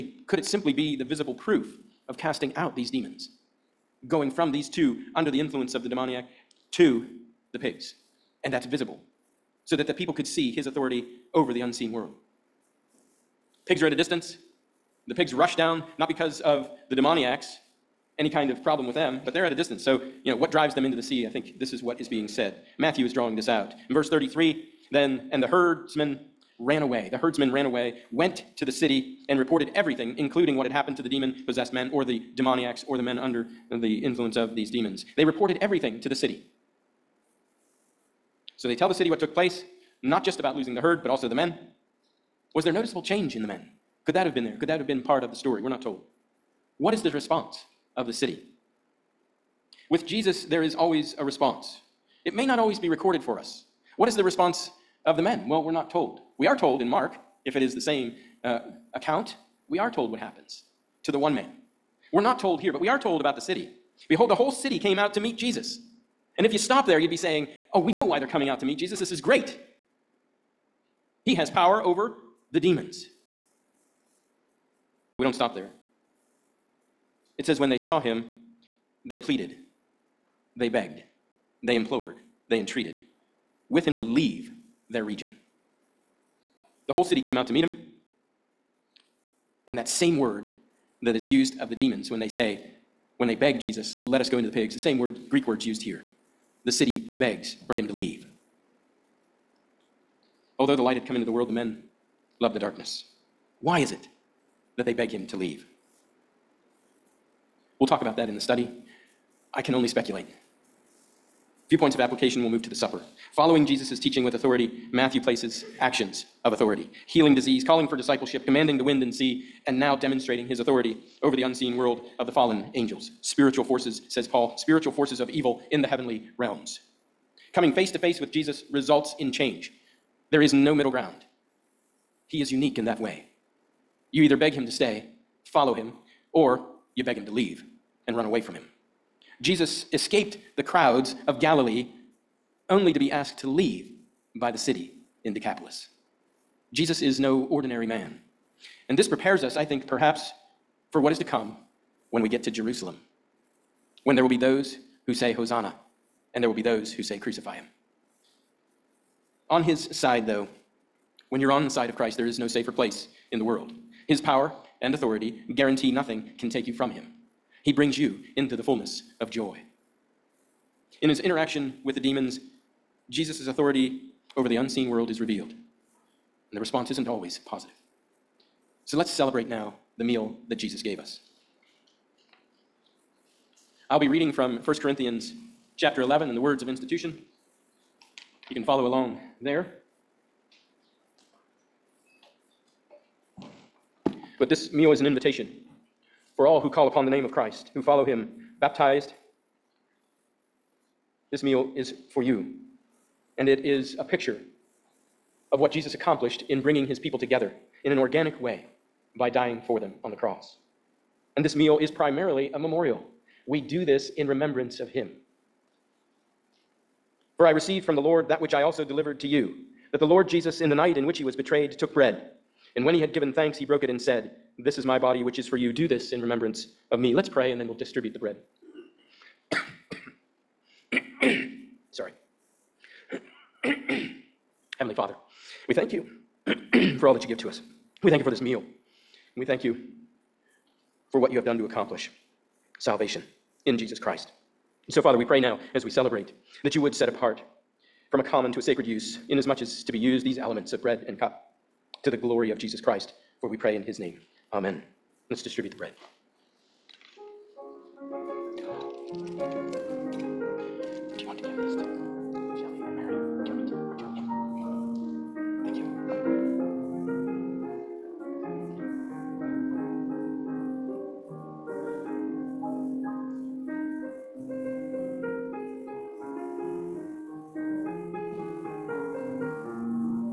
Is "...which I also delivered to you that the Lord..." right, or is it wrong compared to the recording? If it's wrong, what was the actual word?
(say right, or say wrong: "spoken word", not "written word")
right.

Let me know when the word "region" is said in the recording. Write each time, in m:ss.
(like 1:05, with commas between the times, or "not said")
1:25.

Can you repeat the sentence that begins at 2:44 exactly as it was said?
His power and authority guarantee nothing can take you from him.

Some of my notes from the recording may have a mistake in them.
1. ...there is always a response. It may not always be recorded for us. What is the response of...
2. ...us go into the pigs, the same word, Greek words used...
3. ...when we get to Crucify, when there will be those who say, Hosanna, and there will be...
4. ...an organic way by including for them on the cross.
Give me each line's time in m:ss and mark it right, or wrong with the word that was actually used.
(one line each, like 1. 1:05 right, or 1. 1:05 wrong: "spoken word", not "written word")
1. 0:50 right
2. 1:34 right
3. 2:32 wrong: "Jerusalem", not "Crucify"
4. 3:27 wrong: "dying", not "including".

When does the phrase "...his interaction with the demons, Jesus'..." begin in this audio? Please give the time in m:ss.
2:51.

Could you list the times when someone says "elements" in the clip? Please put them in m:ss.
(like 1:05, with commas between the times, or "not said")
4:10.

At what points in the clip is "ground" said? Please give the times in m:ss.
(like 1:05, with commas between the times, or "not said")
2:10.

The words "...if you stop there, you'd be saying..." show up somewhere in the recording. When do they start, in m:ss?
1:06.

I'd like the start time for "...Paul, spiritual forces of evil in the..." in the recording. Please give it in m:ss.
2:04.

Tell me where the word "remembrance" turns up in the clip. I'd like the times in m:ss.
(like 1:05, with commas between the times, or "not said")
3:34, 3:46.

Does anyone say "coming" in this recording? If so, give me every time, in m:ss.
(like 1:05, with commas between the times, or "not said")
1:08, 2:07.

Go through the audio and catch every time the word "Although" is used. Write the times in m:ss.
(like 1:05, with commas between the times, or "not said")
1:40.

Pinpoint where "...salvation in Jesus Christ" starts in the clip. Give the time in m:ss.
4:02.